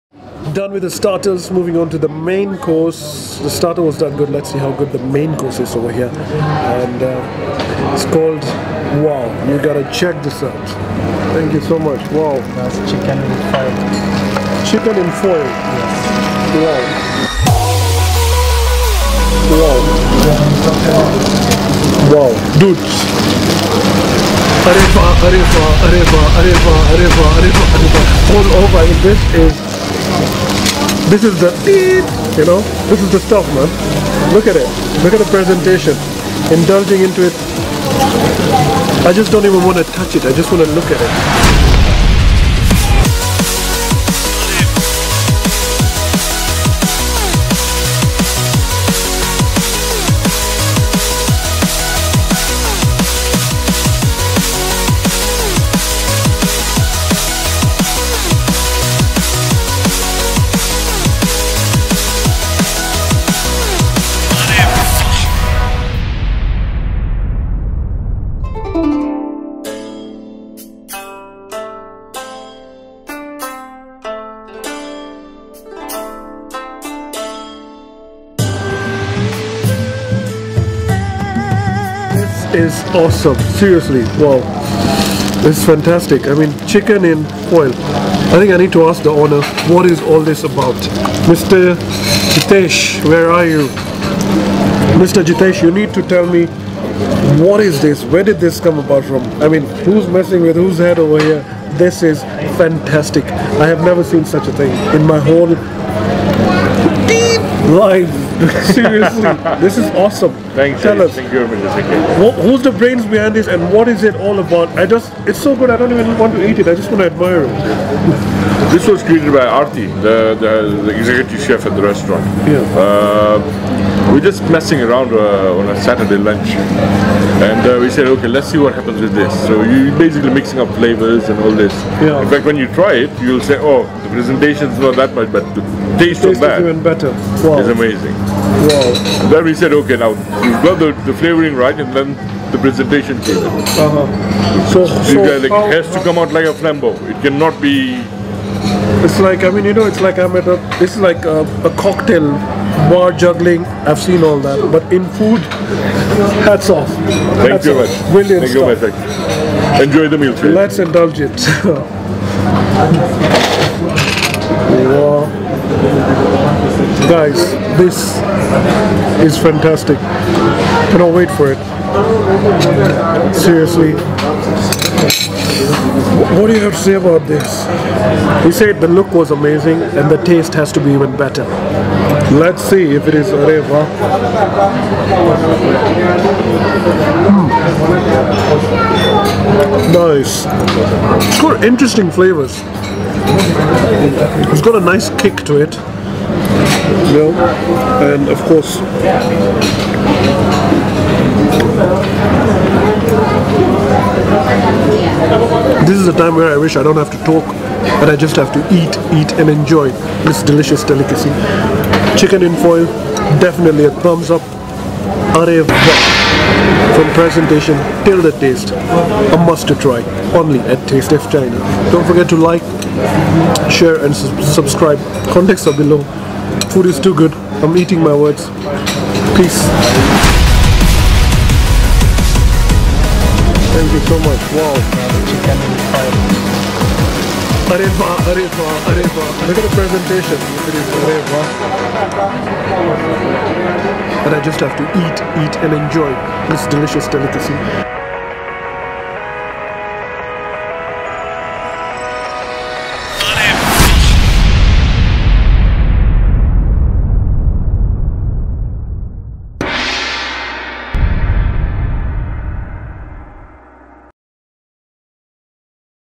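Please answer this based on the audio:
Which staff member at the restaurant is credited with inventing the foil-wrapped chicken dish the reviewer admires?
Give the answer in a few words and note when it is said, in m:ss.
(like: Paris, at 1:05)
Arti, at 1:59.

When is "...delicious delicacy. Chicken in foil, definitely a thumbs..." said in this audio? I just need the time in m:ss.
3:30.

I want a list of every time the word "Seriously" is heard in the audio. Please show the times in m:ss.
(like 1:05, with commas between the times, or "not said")
1:23, 1:48, 2:53.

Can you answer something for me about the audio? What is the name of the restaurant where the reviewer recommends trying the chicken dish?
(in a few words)
Taste of China.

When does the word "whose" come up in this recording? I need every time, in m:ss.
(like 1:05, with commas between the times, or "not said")
1:40.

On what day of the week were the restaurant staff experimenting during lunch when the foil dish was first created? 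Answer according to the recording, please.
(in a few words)
Saturday.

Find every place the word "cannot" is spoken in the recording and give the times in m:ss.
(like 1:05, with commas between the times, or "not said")
2:27, 2:50.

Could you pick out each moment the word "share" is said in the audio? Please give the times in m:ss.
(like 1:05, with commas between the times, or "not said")
3:43.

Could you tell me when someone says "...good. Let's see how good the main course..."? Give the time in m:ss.
0:04.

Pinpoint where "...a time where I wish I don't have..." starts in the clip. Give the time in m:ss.
3:26.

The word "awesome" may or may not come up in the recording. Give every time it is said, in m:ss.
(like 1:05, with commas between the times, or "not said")
1:22, 1:49.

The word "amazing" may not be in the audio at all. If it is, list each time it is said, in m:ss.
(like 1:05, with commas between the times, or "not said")
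2:17, 2:59.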